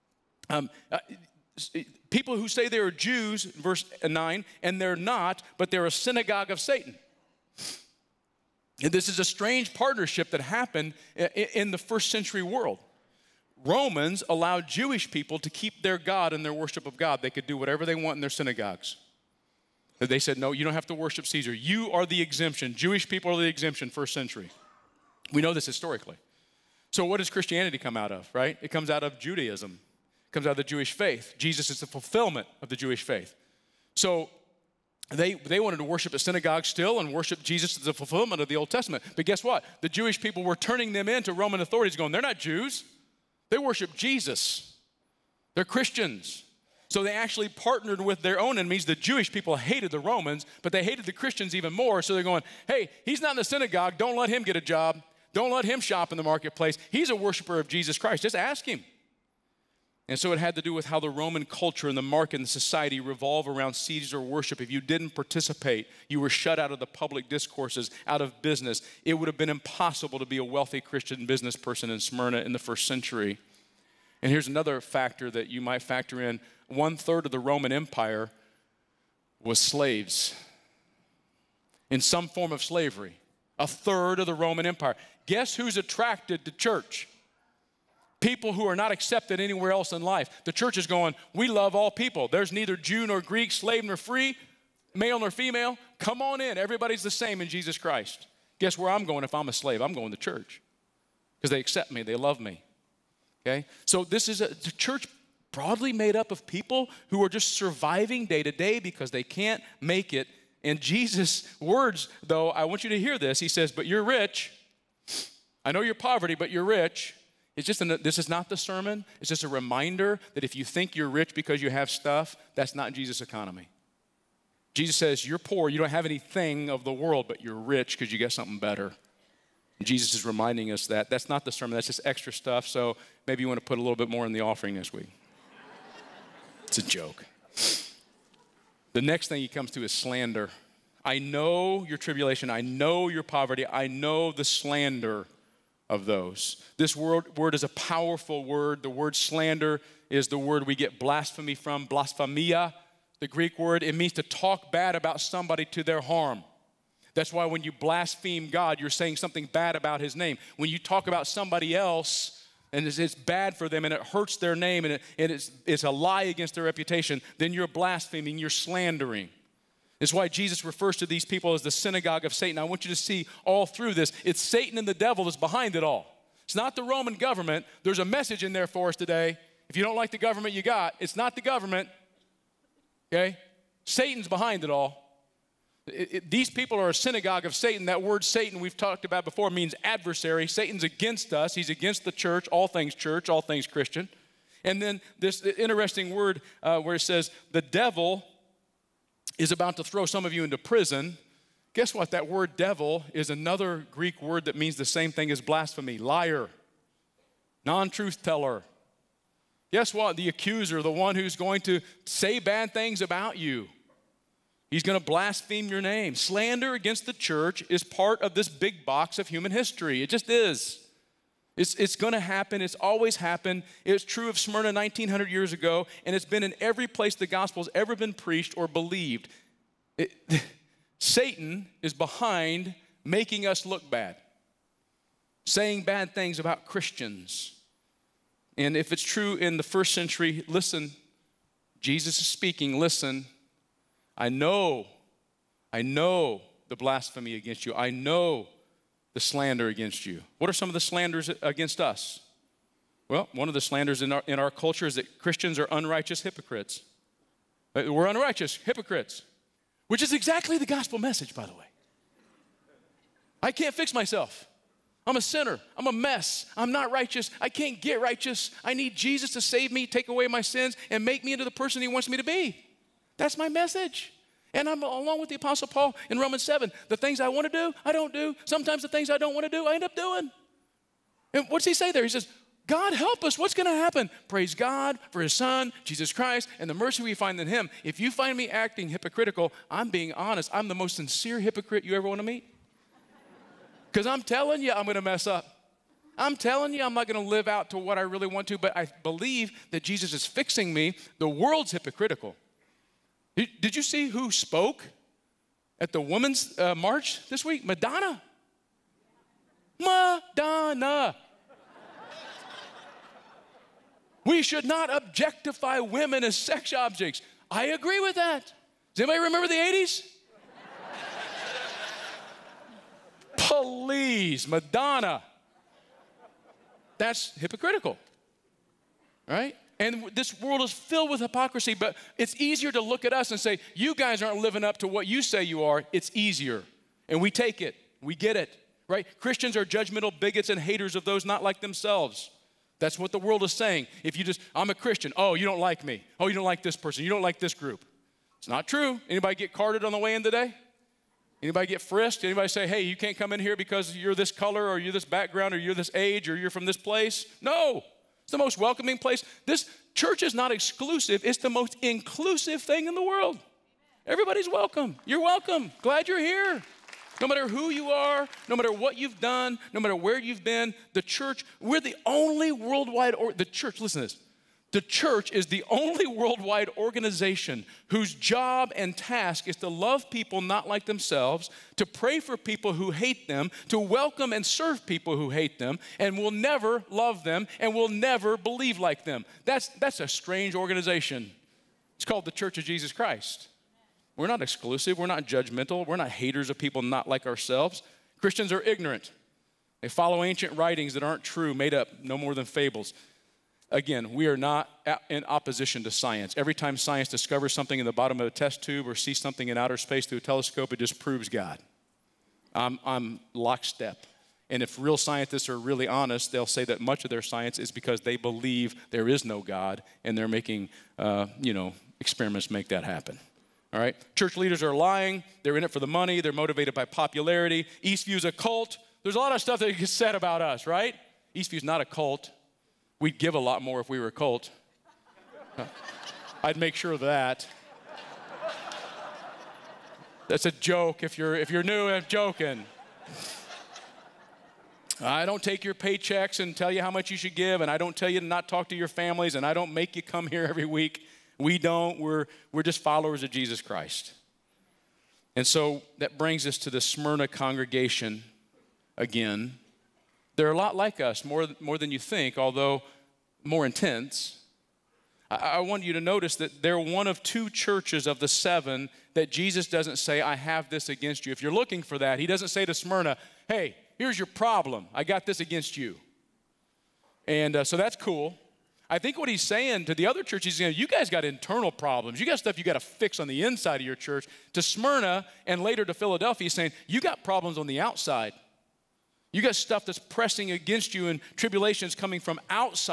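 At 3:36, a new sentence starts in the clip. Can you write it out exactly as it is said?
Slander against the church is part of this big box of human history.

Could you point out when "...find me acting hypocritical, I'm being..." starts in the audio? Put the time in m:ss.
4:48.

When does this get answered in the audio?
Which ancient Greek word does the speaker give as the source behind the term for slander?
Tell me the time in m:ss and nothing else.
2:31.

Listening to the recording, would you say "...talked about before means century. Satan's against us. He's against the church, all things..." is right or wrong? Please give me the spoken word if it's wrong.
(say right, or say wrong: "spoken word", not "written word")
wrong: "adversary", not "century".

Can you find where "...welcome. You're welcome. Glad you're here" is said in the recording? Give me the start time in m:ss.
6:04.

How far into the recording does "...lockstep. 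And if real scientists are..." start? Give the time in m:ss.
6:53.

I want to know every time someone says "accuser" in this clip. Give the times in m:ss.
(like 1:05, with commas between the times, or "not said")
3:30.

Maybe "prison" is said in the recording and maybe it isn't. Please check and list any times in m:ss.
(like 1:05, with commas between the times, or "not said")
3:20.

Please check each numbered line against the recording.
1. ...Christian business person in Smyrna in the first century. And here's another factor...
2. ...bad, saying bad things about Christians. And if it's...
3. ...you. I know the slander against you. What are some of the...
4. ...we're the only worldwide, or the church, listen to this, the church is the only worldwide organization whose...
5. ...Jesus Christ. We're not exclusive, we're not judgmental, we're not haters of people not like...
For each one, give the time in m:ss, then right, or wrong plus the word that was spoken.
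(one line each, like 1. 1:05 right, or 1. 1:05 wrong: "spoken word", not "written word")
1. 1:10 right
2. 3:53 right
3. 4:07 right
4. 6:11 right
5. 6:32 right.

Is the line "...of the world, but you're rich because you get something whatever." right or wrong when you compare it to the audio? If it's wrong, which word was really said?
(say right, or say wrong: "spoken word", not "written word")
wrong: "better", not "whatever".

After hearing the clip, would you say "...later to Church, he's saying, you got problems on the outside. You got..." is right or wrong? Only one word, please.
wrong.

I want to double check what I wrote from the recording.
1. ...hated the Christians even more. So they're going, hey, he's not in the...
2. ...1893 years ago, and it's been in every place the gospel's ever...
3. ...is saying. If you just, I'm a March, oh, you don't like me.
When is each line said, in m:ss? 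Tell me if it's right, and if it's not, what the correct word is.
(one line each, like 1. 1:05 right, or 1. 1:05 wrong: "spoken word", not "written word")
1. 0:50 right
2. 3:44 wrong: "1900", not "1893"
3. 5:43 wrong: "Christian", not "March".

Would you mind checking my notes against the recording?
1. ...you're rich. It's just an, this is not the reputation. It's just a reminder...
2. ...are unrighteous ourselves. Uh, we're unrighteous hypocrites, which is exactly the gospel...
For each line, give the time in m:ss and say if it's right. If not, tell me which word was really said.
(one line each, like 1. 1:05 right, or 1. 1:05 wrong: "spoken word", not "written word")
1. 1:56 wrong: "sermon", not "reputation"
2. 4:15 wrong: "hypocrites", not "ourselves".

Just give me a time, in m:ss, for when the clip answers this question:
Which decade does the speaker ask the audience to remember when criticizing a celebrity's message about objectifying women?
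5:19.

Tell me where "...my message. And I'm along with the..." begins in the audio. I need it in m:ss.
4:33.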